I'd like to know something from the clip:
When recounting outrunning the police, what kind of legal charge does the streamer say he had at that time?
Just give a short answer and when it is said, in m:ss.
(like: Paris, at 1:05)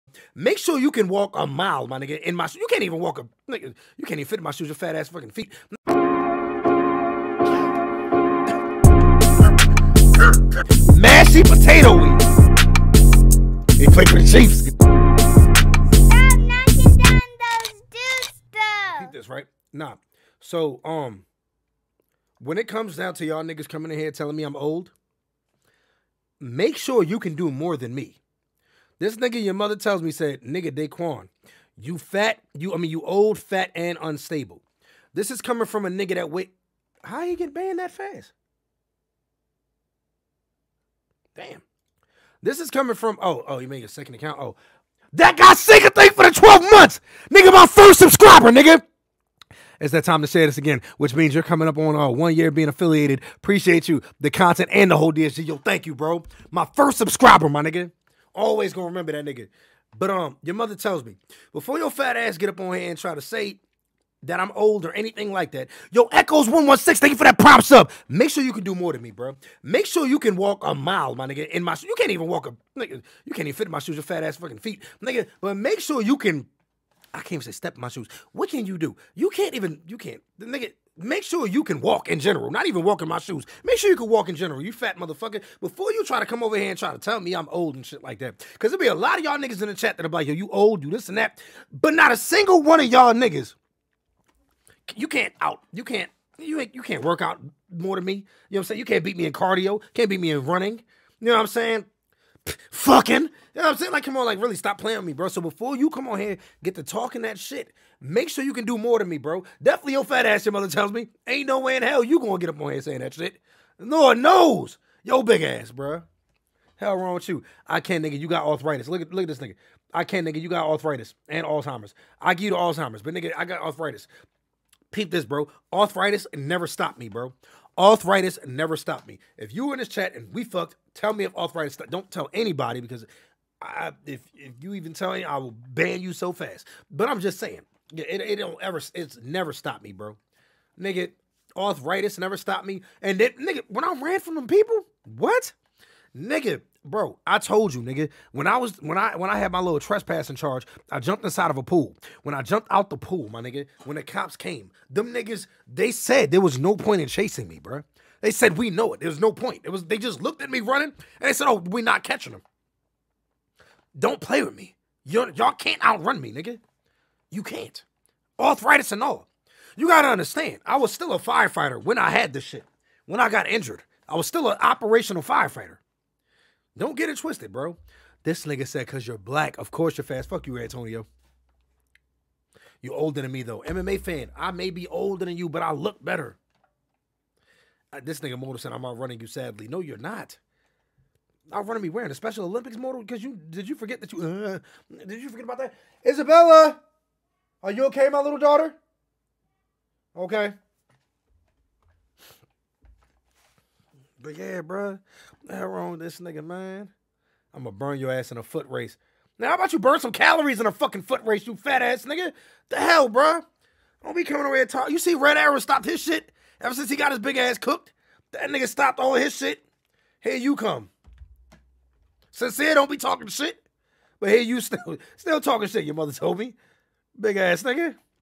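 trespassing, at 2:29.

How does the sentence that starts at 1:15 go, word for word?
But make sure you can I can't even say step in my shoes.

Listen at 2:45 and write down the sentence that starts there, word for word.
You're, y'all can't outrun me, nigga.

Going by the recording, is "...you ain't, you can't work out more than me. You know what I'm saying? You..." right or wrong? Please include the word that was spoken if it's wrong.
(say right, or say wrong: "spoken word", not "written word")
right.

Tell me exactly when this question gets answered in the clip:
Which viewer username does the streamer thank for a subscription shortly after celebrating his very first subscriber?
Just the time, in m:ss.
1:06.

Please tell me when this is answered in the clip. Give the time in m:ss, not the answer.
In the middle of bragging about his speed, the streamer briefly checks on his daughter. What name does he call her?
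3:16.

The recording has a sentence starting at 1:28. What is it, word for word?
Because there'll be a lot of y'all niggas in the chat that are like, yo, you old, you this and that.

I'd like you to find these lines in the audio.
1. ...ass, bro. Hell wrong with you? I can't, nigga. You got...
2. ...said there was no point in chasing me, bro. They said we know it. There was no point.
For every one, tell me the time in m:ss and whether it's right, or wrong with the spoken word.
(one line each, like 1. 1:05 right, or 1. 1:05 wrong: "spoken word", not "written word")
1. 1:55 right
2. 2:35 right.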